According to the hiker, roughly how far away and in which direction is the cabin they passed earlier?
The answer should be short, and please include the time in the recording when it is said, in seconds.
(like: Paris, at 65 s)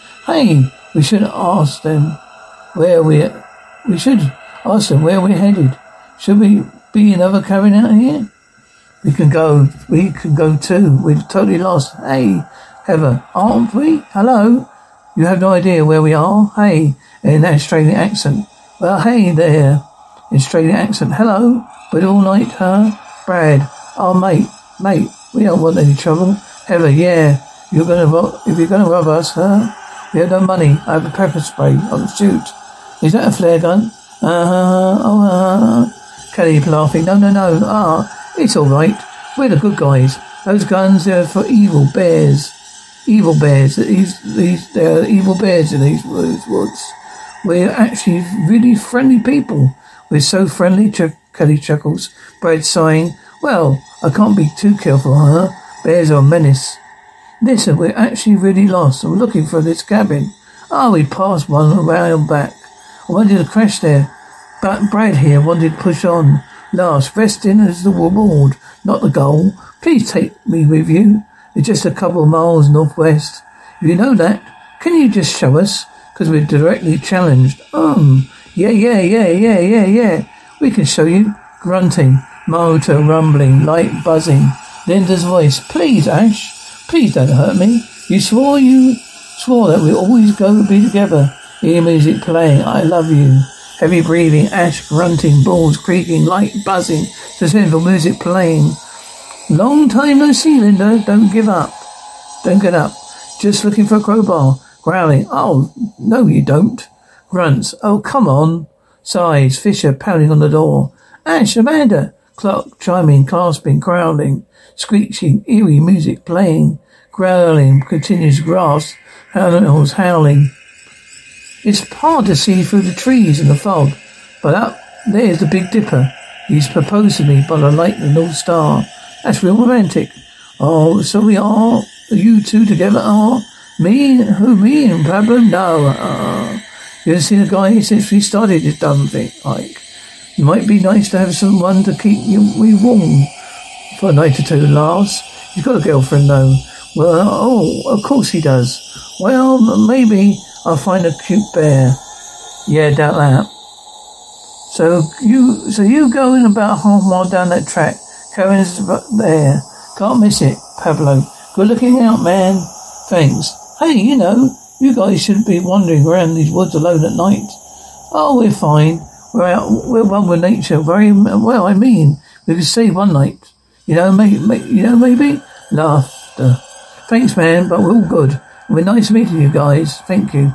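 a couple of miles northwest, at 71 s.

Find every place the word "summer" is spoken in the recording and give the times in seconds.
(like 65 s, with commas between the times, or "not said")
not said.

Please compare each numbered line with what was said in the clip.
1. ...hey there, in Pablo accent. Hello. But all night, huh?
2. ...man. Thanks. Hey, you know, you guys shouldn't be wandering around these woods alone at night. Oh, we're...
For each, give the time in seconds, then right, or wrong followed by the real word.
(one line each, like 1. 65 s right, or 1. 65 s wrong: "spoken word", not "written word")
1. 19 s wrong: "Australian", not "Pablo"
2. 162 s right.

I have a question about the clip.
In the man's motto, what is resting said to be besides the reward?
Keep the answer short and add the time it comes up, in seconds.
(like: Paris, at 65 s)
the goal, at 69 s.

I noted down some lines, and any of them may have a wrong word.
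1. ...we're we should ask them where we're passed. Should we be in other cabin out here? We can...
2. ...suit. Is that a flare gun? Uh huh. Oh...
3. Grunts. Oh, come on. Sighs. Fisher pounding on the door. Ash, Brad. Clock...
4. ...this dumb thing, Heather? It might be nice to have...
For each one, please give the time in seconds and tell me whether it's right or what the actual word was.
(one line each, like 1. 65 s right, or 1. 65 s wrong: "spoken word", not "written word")
1. 3 s wrong: "headed", not "passed"
2. 32 s right
3. 107 s wrong: "Amanda", not "Brad"
4. 138 s wrong: "Ike", not "Heather".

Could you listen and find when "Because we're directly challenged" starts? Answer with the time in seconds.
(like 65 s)
76 s.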